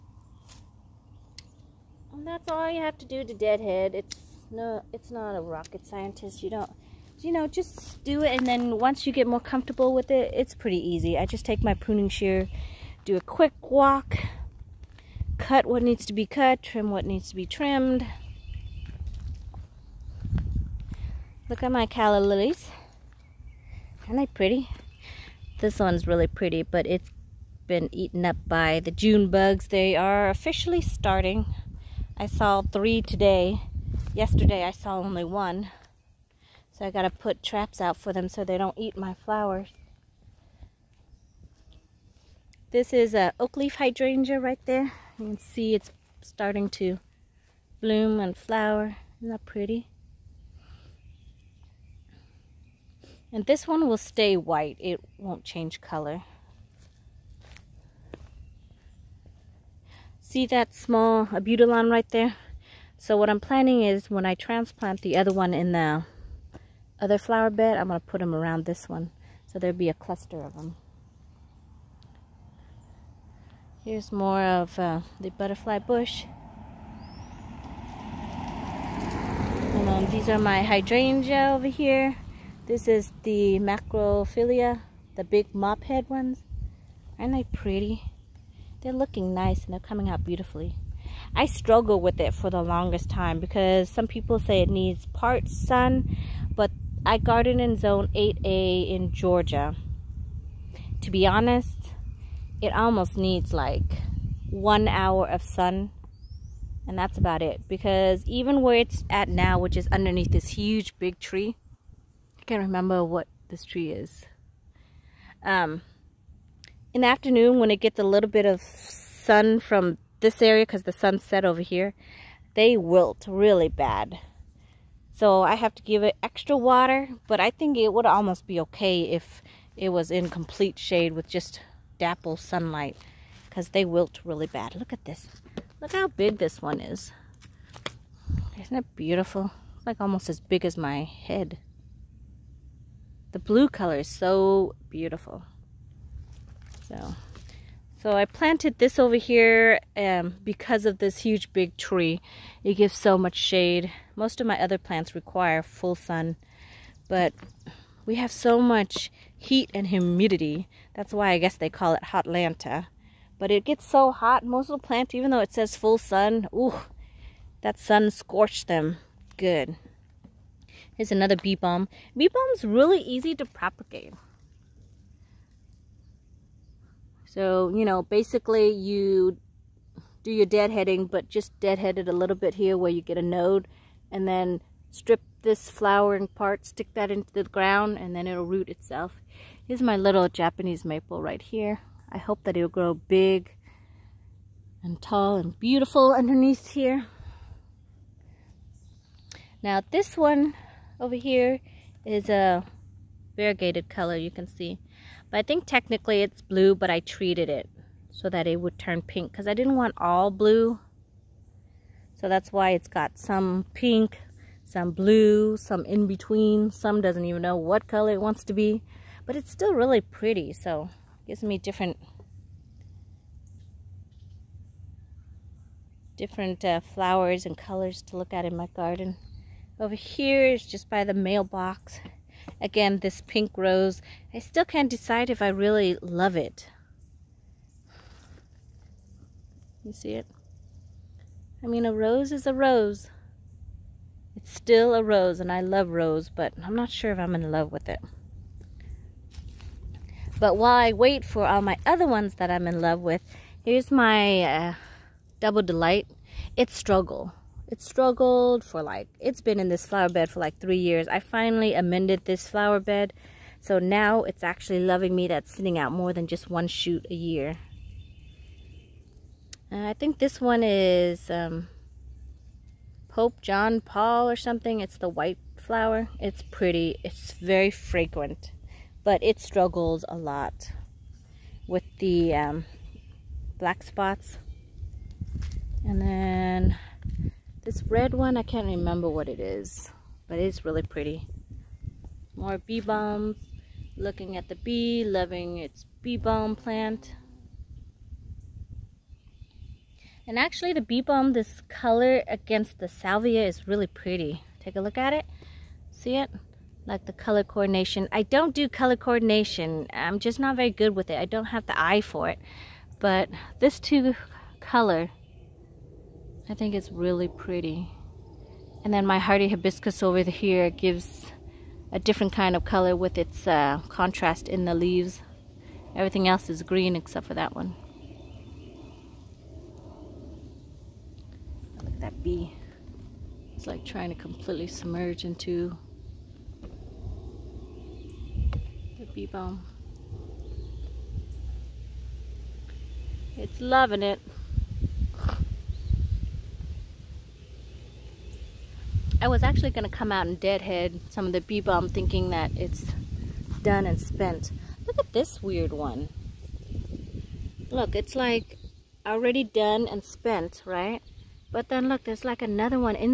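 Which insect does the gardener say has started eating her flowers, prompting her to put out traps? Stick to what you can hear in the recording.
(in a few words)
June bugs.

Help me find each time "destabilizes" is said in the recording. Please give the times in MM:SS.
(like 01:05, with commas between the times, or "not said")
not said.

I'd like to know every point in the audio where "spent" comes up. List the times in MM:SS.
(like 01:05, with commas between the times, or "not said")
05:53, 06:00.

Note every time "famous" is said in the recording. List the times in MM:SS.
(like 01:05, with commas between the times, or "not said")
not said.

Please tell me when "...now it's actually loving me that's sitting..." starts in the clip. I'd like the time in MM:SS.
04:23.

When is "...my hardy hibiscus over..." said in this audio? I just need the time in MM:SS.
05:19.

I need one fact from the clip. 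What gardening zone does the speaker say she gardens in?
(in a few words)
8A.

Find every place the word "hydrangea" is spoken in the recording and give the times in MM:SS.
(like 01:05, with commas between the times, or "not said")
00:43, 01:20.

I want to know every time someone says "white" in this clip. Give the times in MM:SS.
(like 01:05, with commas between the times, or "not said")
00:54, 04:35.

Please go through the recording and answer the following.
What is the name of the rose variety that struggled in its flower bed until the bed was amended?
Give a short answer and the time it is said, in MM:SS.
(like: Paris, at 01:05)
Double Delight, at 04:15.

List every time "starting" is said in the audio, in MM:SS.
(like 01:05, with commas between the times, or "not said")
00:30, 00:46.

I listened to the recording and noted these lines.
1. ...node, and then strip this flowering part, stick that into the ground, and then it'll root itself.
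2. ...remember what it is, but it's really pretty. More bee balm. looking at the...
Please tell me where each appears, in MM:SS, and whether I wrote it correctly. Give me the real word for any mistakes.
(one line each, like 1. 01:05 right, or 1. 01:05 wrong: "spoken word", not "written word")
1. 03:03 right
2. 04:48 right.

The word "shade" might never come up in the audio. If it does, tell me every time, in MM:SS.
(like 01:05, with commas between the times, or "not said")
02:10, 02:33.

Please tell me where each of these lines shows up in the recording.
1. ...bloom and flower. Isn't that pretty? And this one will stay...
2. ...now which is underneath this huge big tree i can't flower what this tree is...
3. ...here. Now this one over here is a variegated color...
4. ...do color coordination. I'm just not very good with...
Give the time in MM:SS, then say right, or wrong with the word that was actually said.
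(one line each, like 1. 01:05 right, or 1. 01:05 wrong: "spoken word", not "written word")
1. 00:47 right
2. 01:49 wrong: "remember", not "flower"
3. 03:16 right
4. 05:08 right.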